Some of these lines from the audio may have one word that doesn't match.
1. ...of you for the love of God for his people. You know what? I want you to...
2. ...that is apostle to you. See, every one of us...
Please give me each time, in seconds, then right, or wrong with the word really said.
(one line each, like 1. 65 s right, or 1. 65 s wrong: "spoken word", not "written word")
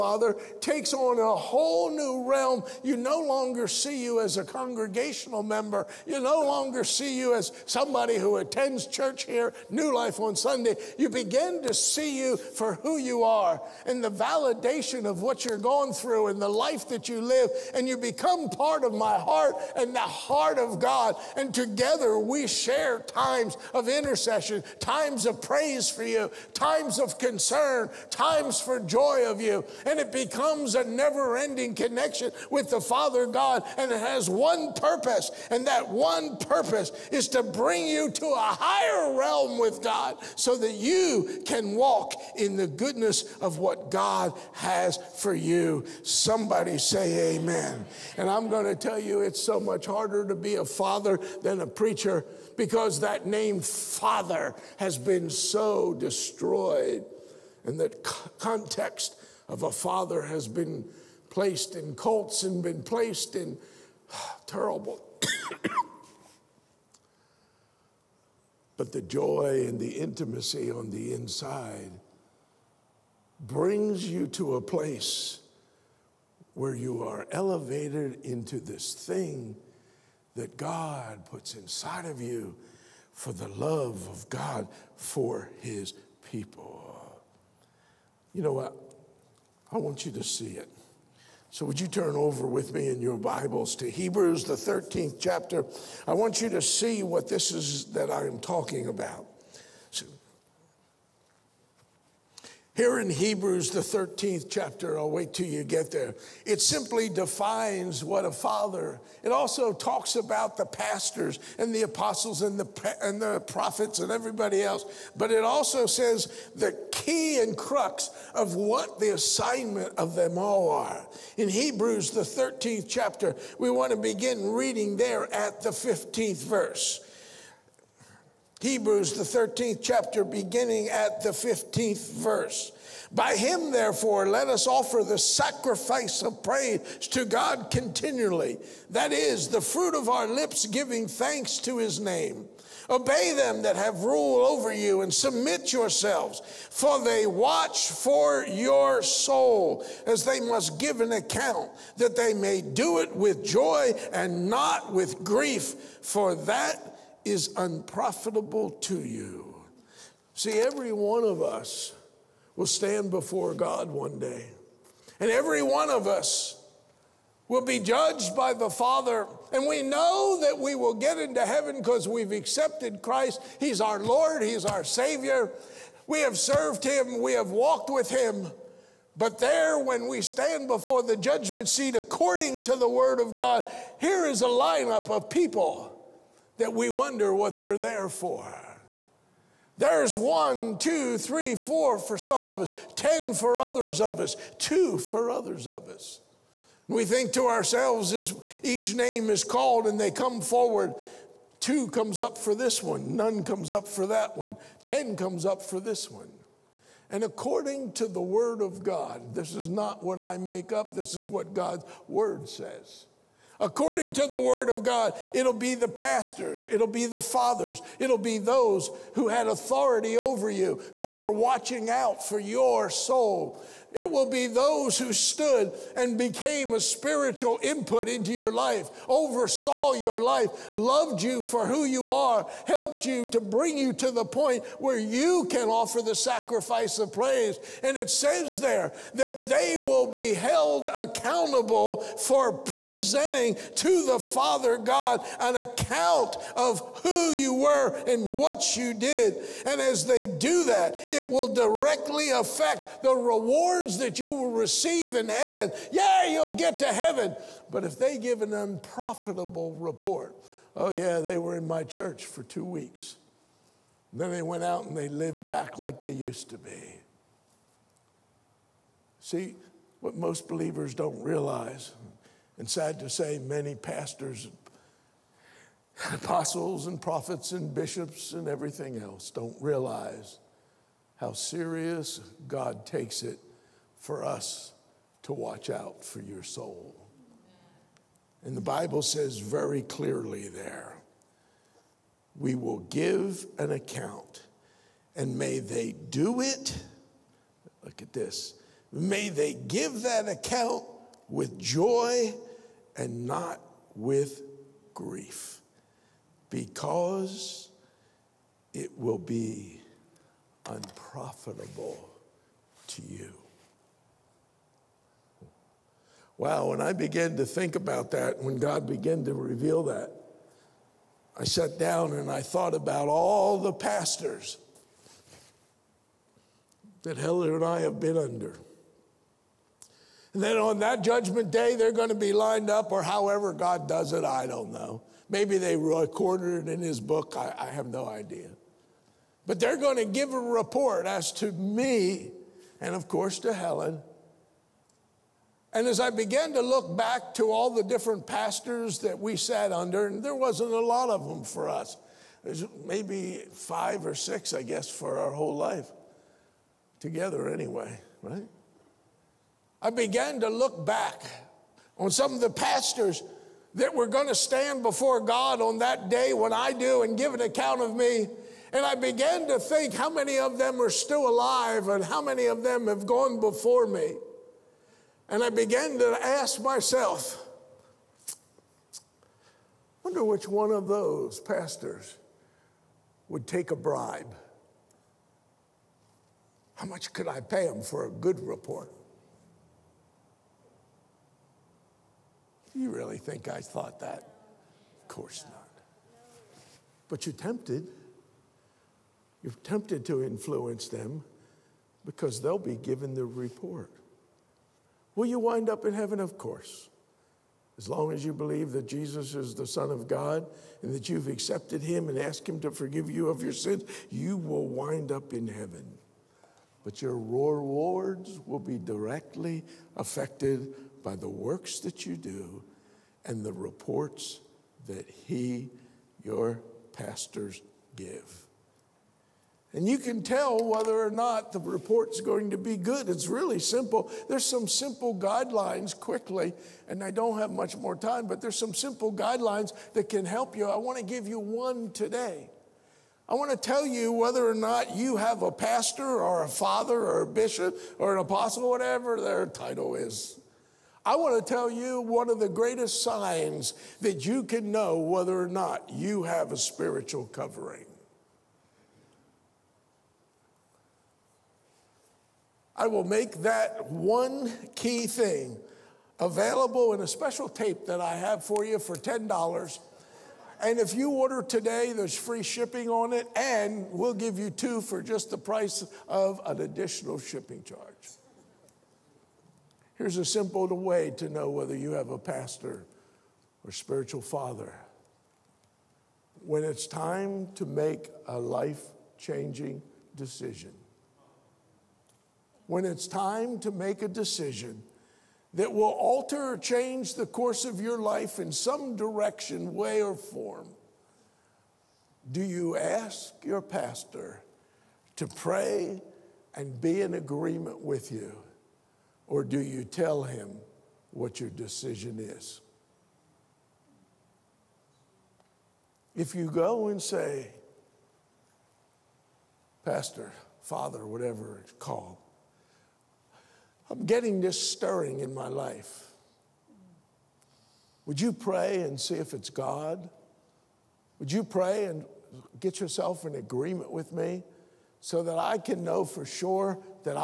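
1. 82 s right
2. 156 s wrong: "unprofitable", not "apostle".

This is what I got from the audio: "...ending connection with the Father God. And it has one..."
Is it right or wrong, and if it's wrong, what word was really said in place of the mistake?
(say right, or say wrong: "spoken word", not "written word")
right.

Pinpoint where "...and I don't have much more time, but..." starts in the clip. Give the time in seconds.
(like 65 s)
436 s.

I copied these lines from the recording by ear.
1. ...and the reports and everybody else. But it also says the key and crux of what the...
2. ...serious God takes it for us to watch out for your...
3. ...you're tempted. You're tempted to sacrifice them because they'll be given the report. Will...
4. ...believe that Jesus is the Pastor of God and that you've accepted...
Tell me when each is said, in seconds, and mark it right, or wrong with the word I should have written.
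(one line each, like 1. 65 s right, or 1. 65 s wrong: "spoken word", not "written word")
1. 113 s wrong: "prophets", not "reports"
2. 281 s right
3. 397 s wrong: "influence", not "sacrifice"
4. 408 s wrong: "Son", not "Pastor".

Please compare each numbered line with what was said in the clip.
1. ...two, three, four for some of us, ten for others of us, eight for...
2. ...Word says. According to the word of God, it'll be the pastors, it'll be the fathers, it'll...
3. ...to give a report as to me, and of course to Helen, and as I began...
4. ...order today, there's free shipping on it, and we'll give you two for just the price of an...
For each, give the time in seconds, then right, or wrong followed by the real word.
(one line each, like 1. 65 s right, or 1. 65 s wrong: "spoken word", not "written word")
1. 190 s wrong: "two", not "eight"
2. 212 s right
3. 339 s right
4. 471 s right.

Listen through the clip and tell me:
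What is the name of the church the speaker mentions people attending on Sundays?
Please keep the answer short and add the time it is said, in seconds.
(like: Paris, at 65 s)
New Life, at 9 s.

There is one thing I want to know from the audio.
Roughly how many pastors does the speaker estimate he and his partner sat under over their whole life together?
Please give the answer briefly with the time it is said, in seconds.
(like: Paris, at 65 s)
five or six, at 353 s.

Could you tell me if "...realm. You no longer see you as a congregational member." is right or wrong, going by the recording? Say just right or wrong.
right.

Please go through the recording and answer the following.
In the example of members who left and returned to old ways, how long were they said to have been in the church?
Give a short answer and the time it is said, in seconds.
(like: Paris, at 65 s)
two weeks, at 262 s.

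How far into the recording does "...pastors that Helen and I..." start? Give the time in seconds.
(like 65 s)
323 s.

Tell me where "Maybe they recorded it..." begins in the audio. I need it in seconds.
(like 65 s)
335 s.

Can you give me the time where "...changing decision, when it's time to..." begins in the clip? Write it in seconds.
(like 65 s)
489 s.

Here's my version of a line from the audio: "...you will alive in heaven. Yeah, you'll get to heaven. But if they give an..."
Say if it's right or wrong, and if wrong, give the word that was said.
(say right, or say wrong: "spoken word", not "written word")
wrong: "receive", not "alive".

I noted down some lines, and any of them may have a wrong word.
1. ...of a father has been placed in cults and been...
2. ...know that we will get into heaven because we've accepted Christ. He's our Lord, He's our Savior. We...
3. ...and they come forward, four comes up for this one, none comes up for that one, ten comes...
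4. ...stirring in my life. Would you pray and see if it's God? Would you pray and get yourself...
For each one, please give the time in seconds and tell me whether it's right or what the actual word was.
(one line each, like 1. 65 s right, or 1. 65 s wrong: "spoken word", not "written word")
1. 59 s right
2. 169 s right
3. 199 s wrong: "two", not "four"
4. 524 s right.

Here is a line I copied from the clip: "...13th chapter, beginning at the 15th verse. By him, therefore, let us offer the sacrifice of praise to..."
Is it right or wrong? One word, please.
right.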